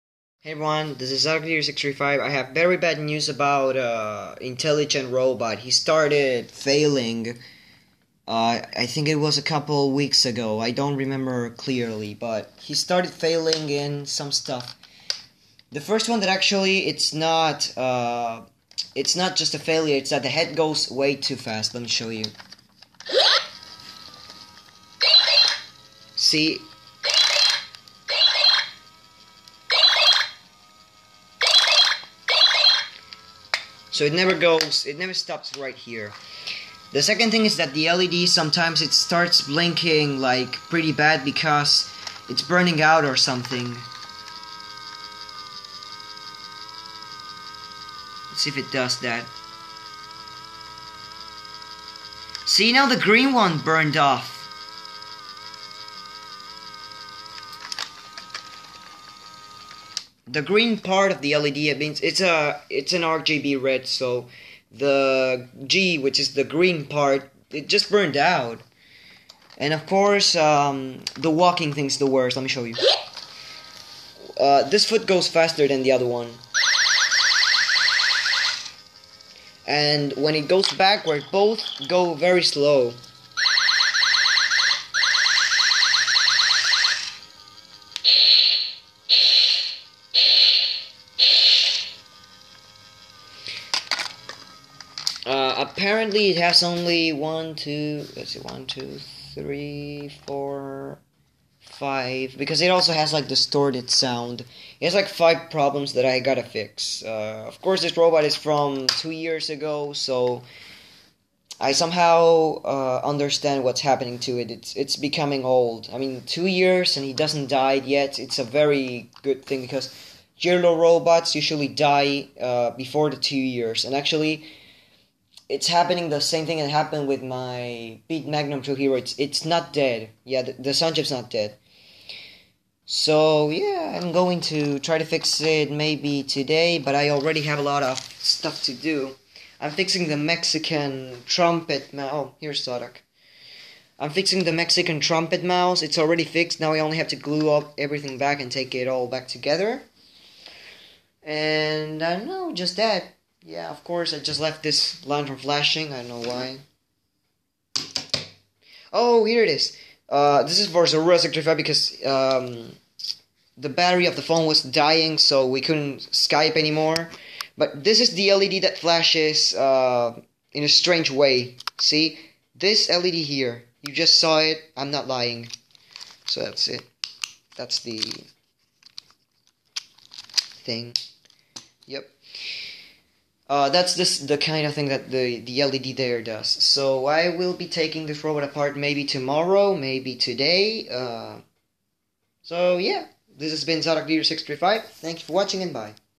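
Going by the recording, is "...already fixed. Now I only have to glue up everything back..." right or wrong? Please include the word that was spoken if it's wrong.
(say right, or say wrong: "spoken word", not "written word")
right.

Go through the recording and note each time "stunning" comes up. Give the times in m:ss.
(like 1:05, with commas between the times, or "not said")
not said.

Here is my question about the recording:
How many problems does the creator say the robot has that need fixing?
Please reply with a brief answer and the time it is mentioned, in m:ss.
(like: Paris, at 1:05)
5, at 1:45.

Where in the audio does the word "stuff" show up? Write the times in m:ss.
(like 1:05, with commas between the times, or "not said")
0:14, 2:18.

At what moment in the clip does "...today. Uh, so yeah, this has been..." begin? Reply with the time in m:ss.
3:10.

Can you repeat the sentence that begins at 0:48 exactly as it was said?
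Let's see if it does that.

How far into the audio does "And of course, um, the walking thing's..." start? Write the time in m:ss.
1:09.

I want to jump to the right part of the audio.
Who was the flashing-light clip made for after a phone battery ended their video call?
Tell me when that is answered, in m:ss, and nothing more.
2:40.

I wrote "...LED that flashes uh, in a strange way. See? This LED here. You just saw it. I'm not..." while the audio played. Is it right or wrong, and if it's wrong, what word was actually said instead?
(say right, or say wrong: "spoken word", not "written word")
right.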